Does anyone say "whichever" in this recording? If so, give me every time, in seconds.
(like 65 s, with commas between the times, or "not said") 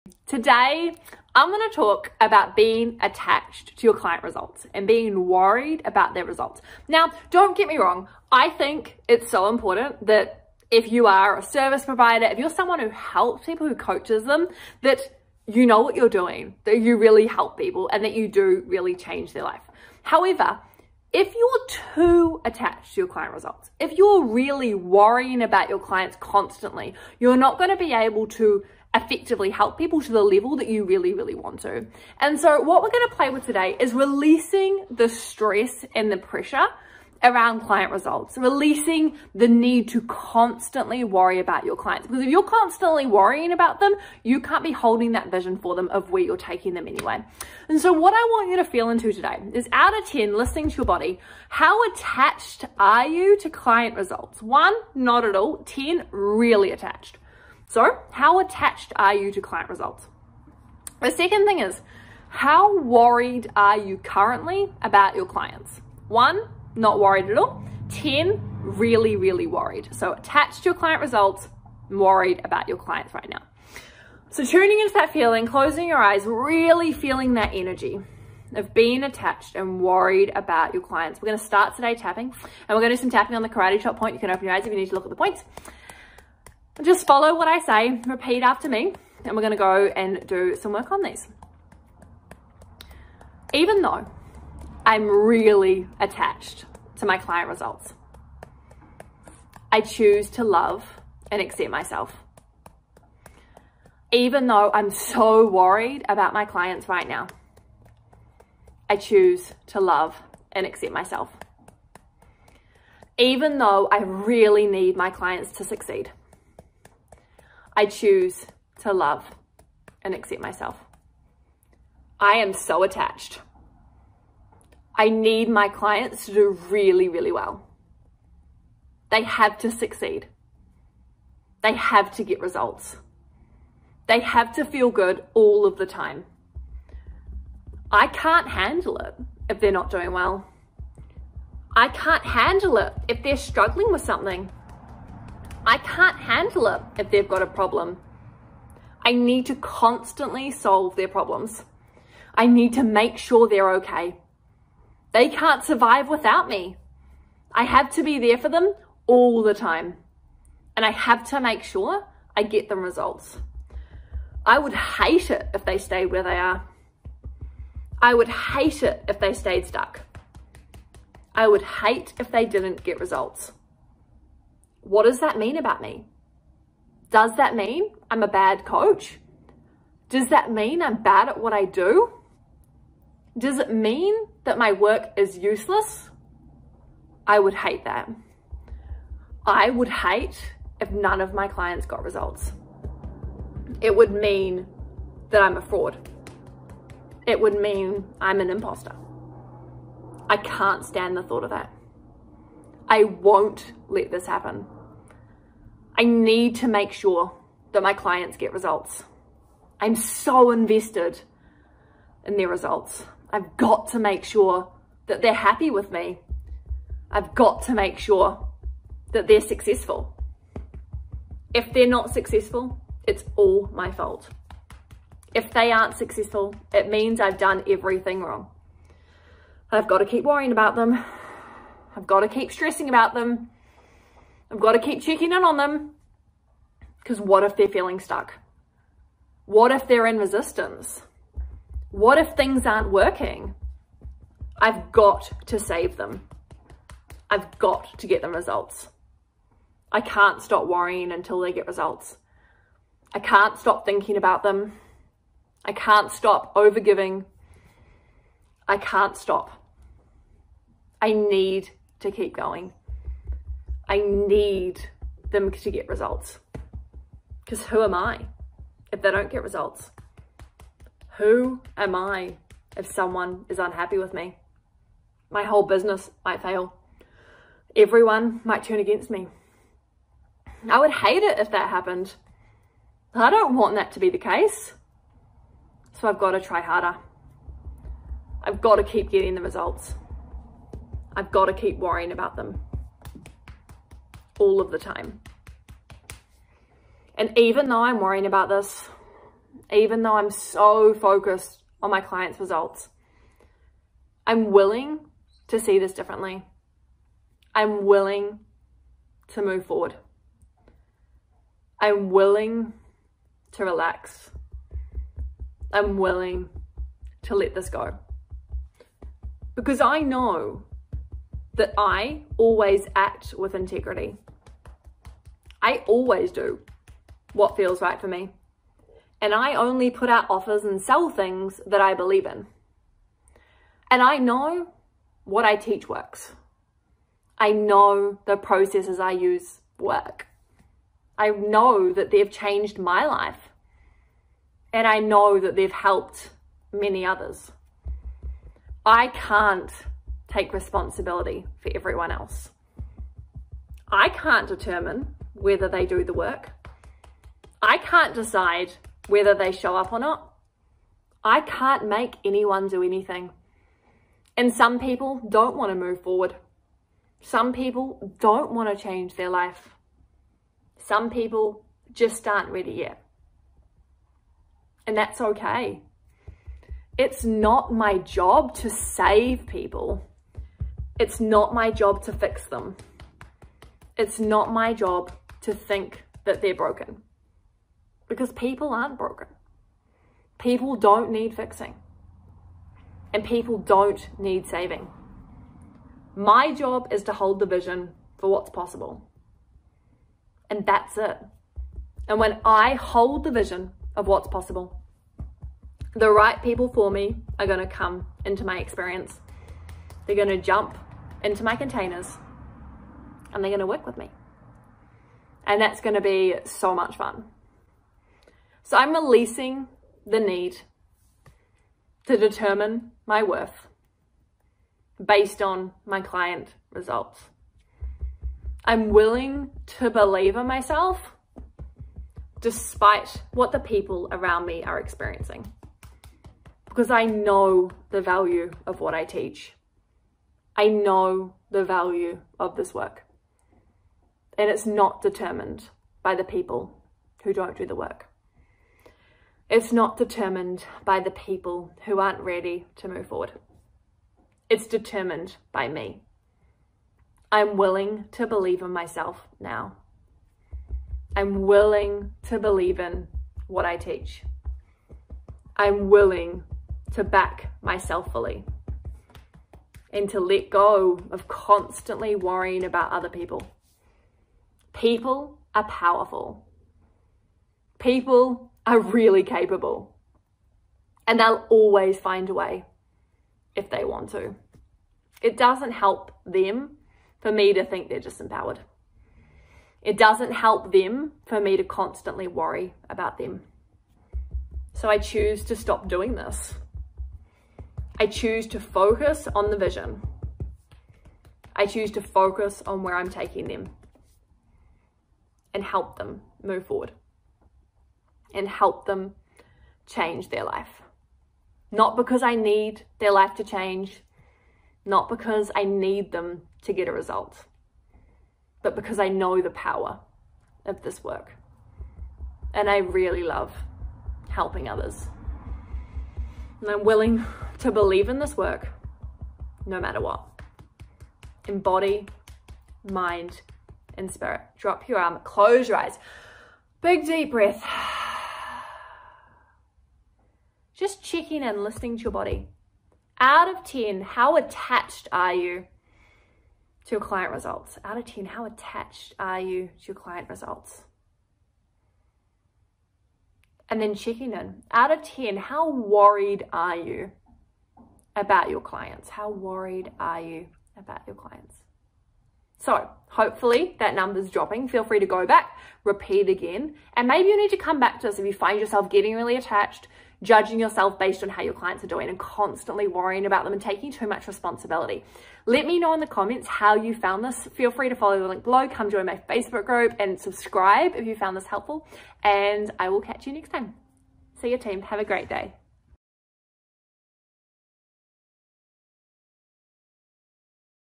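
not said.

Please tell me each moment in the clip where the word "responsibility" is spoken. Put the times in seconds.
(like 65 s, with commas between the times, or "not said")
350 s, 574 s.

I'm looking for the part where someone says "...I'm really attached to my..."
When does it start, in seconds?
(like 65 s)
94 s.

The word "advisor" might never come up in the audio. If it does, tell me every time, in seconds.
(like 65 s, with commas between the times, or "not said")
not said.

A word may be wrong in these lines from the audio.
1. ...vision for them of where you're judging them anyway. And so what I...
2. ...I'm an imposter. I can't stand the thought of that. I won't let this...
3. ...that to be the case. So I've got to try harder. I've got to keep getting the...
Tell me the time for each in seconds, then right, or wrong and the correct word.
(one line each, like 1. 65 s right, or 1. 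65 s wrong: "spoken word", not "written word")
1. 45 s wrong: "taking", not "judging"
2. 198 s right
3. 283 s right.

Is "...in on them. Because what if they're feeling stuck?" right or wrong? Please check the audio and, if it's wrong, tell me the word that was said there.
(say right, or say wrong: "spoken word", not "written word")
right.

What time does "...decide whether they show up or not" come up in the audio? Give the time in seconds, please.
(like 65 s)
358 s.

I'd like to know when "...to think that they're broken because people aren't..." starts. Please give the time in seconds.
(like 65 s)
385 s.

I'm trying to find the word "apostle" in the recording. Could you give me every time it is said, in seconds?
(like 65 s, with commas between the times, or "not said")
not said.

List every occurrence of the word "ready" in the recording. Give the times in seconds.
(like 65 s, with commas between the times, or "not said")
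372 s, 452 s.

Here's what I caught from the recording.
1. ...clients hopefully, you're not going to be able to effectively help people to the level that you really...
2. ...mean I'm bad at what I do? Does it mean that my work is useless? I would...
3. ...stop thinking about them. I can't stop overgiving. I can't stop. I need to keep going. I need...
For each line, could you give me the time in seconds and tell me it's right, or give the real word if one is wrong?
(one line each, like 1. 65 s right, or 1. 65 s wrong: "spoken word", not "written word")
1. 25 s wrong: "constantly", not "hopefully"
2. 180 s right
3. 253 s right.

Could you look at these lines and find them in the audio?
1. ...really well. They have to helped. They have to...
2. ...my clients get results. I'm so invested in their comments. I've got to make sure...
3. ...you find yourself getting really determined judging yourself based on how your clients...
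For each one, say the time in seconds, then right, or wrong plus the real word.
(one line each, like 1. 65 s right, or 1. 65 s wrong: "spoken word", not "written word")
1. 127 s wrong: "succeed", not "helped"
2. 207 s wrong: "results", not "comments"
3. 568 s wrong: "attached", not "determined".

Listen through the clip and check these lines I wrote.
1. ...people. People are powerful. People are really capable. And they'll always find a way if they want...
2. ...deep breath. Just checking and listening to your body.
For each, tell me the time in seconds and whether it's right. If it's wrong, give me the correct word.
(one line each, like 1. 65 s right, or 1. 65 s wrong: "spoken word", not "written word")
1. 473 s right
2. 537 s right.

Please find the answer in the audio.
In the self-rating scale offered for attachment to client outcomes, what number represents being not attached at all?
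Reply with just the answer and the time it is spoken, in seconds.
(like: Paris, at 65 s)
1, at 54 s.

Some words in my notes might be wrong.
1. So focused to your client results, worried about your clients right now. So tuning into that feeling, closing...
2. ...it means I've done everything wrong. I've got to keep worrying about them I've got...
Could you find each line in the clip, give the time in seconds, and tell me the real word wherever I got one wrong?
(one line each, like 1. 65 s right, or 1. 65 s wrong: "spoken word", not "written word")
1. 69 s wrong: "attached", not "focused"
2. 226 s right.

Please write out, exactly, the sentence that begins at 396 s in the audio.
My job is to hold the vision for what's possible.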